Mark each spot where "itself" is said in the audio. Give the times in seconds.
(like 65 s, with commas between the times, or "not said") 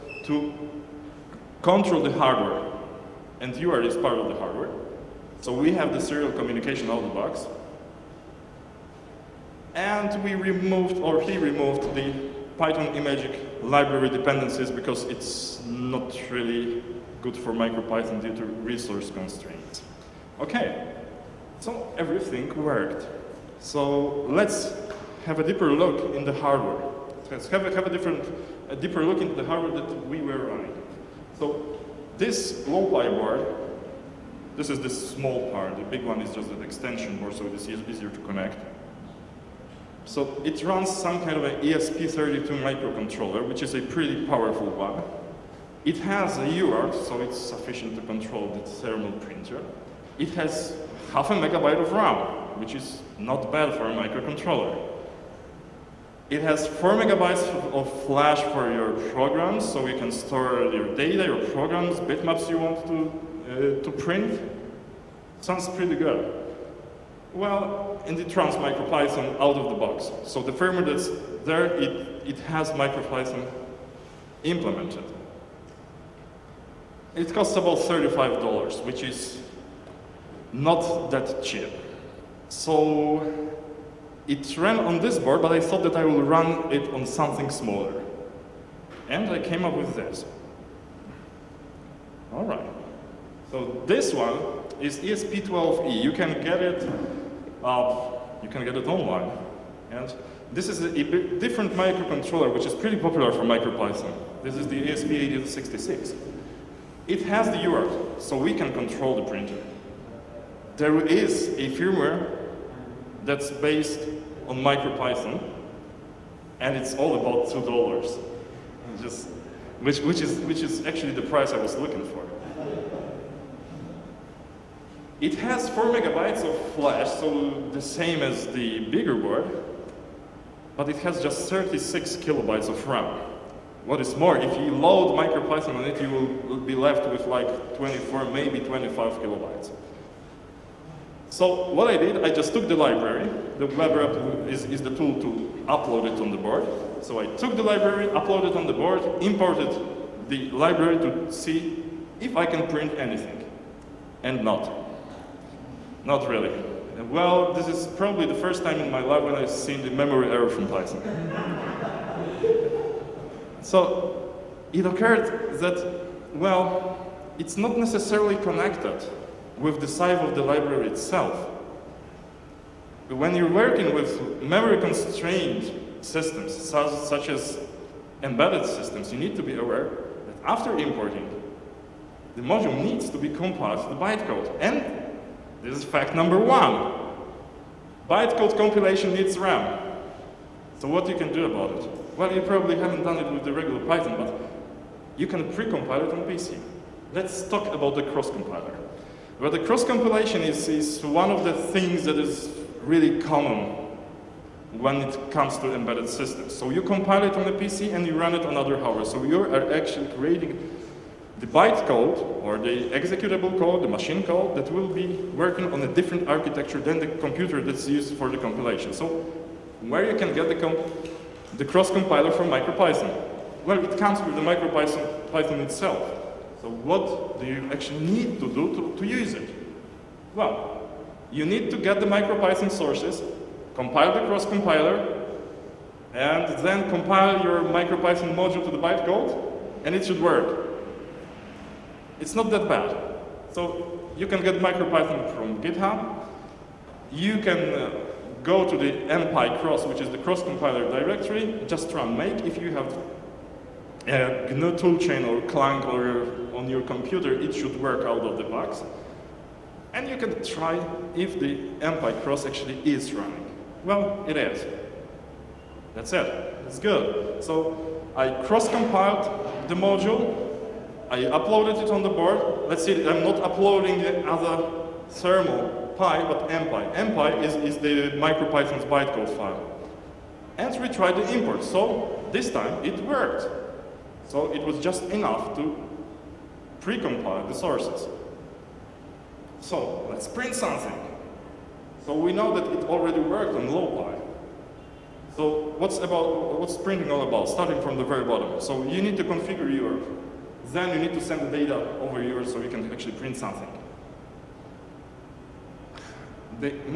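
170 s, 225 s.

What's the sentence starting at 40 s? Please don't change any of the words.
So it runs some kind of an ESP32 microcontroller, which is a pretty powerful one.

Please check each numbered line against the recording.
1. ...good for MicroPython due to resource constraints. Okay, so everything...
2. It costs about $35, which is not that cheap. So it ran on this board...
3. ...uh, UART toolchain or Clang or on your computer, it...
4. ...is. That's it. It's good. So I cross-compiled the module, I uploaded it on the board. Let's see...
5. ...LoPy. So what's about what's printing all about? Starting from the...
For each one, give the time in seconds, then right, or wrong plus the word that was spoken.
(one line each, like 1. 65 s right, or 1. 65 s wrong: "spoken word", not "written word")
1. 17 s right
2. 77 s right
3. 254 s wrong: "GNU", not "UART"
4. 264 s right
5. 293 s right.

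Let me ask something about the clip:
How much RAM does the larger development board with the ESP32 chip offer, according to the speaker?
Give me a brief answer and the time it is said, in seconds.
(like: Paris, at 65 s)
half a megabyte, at 51 s.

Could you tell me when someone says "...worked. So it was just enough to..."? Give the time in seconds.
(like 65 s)
283 s.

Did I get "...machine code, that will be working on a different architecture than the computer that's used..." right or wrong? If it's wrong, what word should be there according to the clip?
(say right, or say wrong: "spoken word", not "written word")
right.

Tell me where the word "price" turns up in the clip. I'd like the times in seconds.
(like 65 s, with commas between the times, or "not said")
121 s.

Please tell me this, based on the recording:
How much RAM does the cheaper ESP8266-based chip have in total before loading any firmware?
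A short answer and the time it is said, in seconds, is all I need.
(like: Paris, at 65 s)
36 kilobytes, at 131 s.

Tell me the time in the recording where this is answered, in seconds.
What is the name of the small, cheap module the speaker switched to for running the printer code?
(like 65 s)
94 s.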